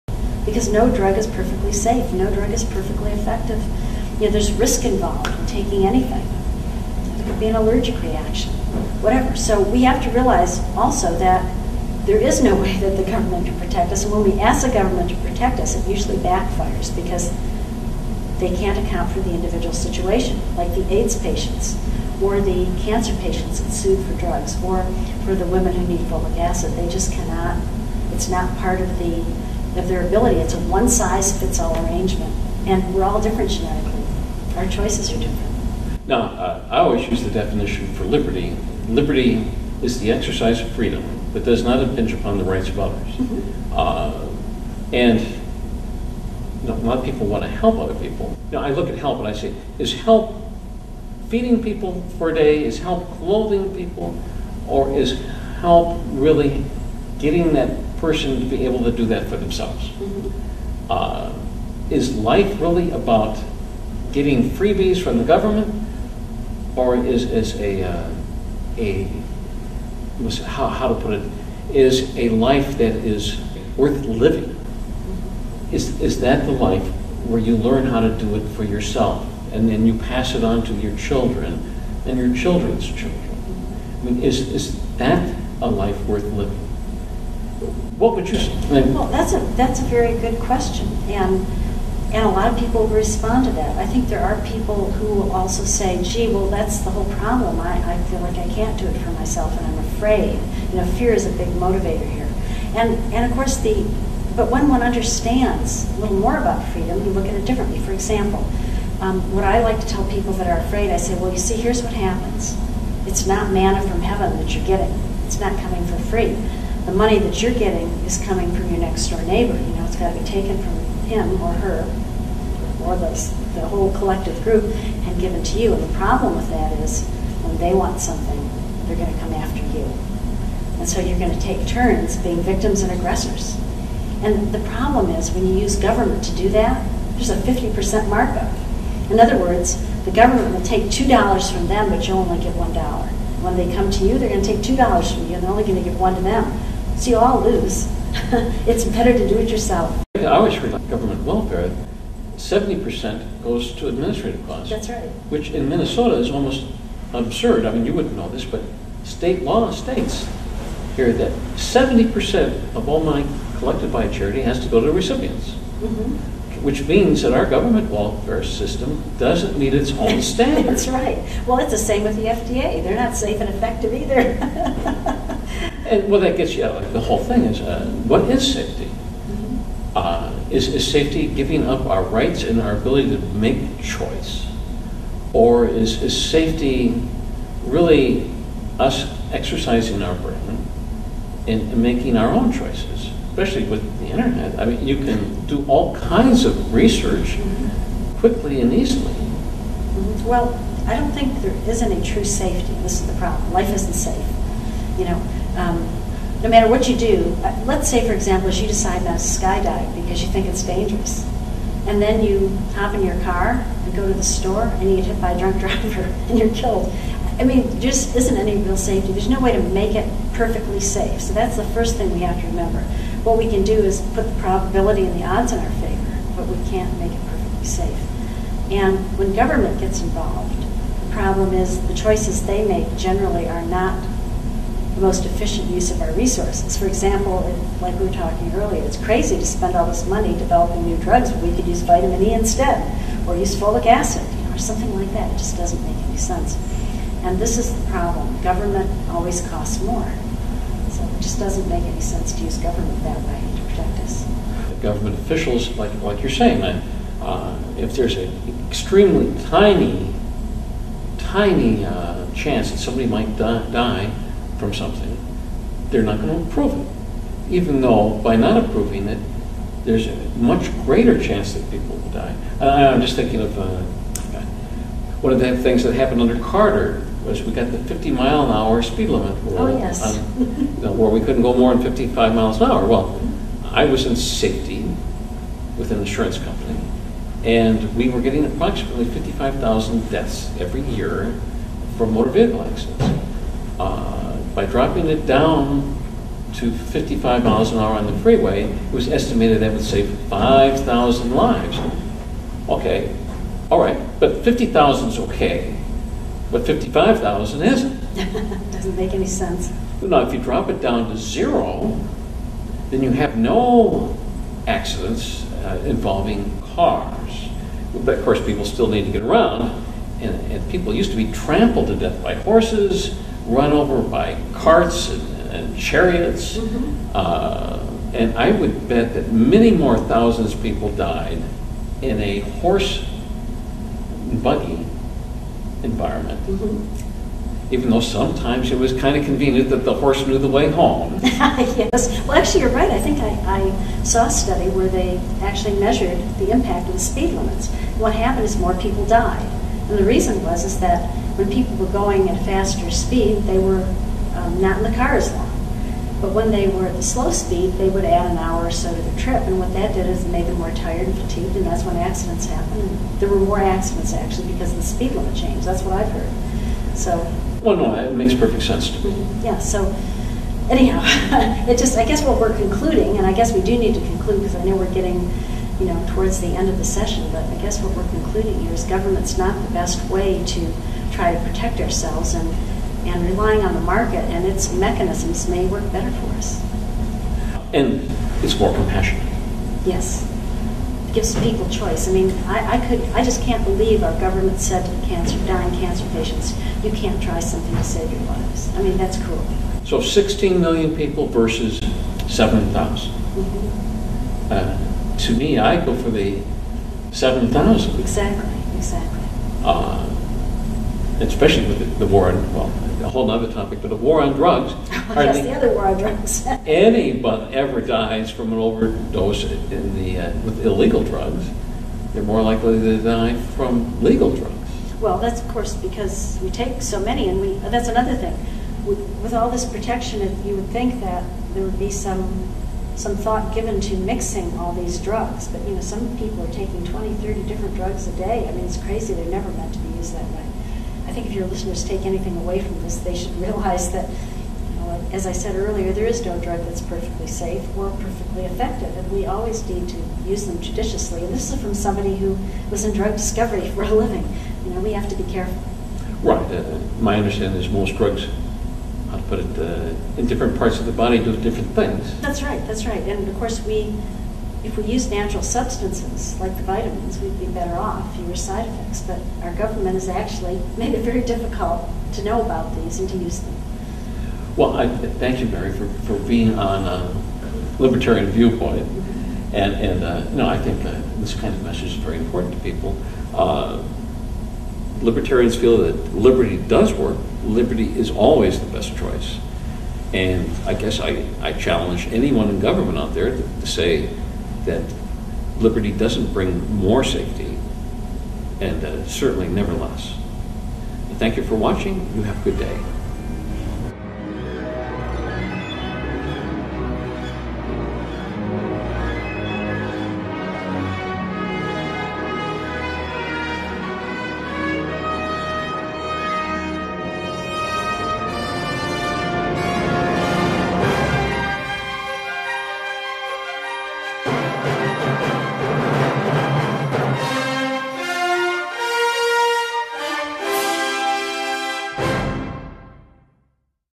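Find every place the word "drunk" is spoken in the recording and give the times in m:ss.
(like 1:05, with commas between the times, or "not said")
3:35.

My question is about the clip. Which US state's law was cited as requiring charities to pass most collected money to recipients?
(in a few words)
Minnesota.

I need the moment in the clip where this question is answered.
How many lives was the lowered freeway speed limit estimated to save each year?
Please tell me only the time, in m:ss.
5:00.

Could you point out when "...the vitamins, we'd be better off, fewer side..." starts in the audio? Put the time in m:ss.
7:46.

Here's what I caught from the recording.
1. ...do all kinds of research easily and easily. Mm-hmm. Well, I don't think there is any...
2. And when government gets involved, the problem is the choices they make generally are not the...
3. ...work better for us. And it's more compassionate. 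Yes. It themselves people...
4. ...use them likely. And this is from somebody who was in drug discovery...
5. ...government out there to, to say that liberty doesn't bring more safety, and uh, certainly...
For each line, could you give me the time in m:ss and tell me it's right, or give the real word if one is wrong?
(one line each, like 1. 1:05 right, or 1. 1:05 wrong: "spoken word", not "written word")
1. 3:15 wrong: "quickly", not "easily"
2. 3:48 right
3. 6:25 wrong: "gives", not "themselves"
4. 7:30 wrong: "judiciously", not "likely"
5. 8:12 right.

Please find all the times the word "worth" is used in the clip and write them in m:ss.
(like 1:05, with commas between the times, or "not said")
1:13, 1:26.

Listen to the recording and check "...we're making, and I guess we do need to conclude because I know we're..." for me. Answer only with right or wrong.
wrong.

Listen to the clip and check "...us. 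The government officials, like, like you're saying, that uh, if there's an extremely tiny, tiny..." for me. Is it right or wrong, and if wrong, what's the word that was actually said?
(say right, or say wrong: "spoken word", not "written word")
right.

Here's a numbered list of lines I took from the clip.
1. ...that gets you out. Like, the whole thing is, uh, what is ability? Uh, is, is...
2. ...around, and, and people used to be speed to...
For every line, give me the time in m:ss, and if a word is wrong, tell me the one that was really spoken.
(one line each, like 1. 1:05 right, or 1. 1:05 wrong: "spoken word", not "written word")
1. 2:56 wrong: "safety", not "ability"
2. 5:19 wrong: "trampled", not "speed".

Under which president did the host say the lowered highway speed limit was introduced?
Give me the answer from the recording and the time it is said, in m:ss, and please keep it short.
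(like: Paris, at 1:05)
Carter, at 4:36.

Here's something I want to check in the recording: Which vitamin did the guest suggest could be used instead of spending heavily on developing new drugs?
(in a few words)
Vitamin E.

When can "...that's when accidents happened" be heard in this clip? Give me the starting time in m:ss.
6:01.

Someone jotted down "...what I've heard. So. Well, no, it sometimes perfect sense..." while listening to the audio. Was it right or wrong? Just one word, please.
wrong.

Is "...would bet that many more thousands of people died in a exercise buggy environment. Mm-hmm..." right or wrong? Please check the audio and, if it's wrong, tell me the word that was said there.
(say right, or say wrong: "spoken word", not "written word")
wrong: "horse", not "exercise".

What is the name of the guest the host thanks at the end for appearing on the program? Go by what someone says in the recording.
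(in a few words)
Mary.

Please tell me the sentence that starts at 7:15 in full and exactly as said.
But you know, some people are taking 20, 30 different drugs a day.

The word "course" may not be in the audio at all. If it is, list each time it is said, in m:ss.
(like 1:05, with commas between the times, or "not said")
1:43, 5:18, 7:05, 7:43.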